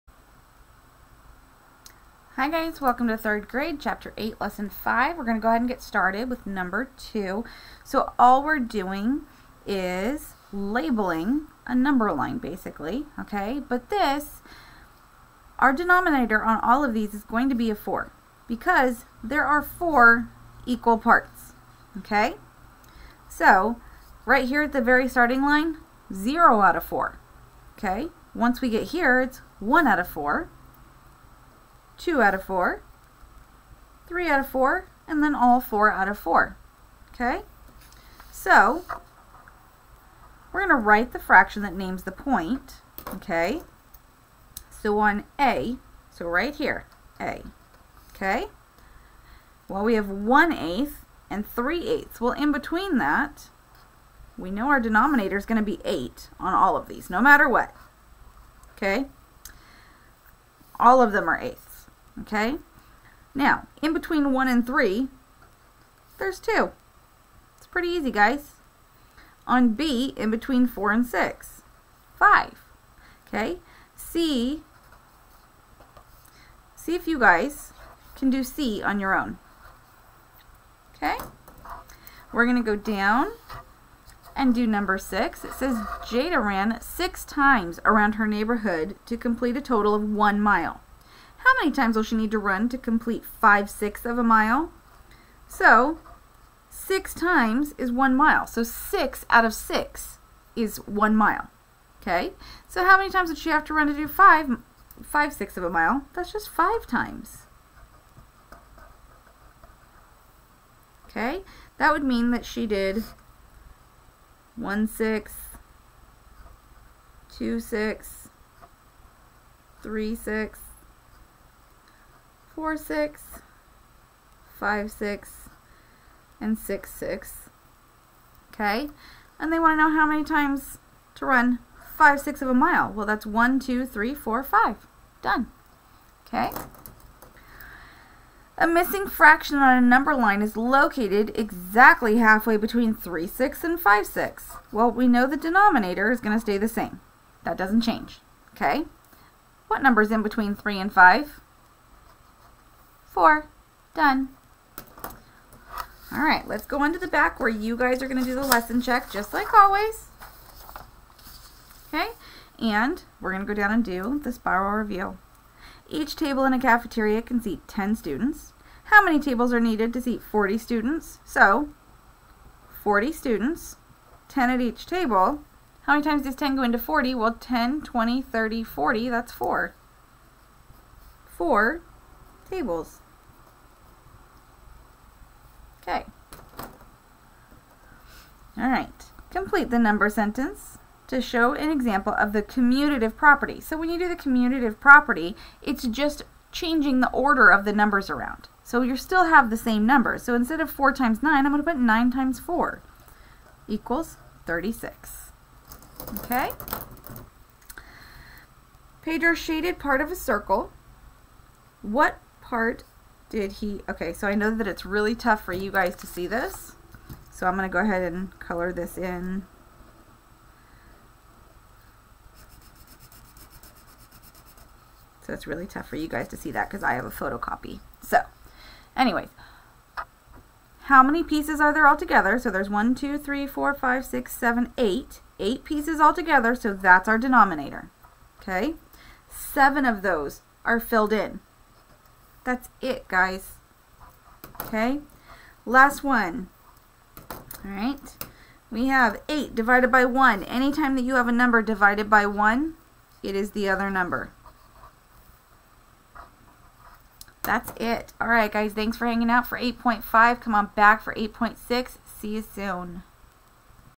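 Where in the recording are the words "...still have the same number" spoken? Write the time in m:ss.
3:18.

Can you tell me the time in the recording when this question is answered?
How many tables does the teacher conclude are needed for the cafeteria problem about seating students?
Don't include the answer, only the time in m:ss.
3:01.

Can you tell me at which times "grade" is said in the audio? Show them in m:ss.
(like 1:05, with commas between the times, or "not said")
0:03.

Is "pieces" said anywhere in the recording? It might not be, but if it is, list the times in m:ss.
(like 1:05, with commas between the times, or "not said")
3:51, 3:55.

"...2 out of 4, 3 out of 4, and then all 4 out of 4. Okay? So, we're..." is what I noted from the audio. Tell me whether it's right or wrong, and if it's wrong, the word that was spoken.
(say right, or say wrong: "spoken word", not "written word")
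right.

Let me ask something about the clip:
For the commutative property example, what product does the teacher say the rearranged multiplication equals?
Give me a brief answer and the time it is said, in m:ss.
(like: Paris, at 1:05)
36, at 3:24.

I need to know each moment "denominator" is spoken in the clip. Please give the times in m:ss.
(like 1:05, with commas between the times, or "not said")
0:15, 0:54, 2:25, 3:57.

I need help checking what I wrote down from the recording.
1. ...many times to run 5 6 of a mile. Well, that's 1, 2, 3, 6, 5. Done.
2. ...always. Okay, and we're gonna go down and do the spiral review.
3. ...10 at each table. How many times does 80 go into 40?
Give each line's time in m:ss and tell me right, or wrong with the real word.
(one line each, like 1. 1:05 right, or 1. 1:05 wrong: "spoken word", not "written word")
1. 2:10 wrong: "4", not "6"
2. 2:39 right
3. 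2:54 wrong: "10", not "80".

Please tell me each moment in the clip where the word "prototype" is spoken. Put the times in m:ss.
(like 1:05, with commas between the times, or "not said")
not said.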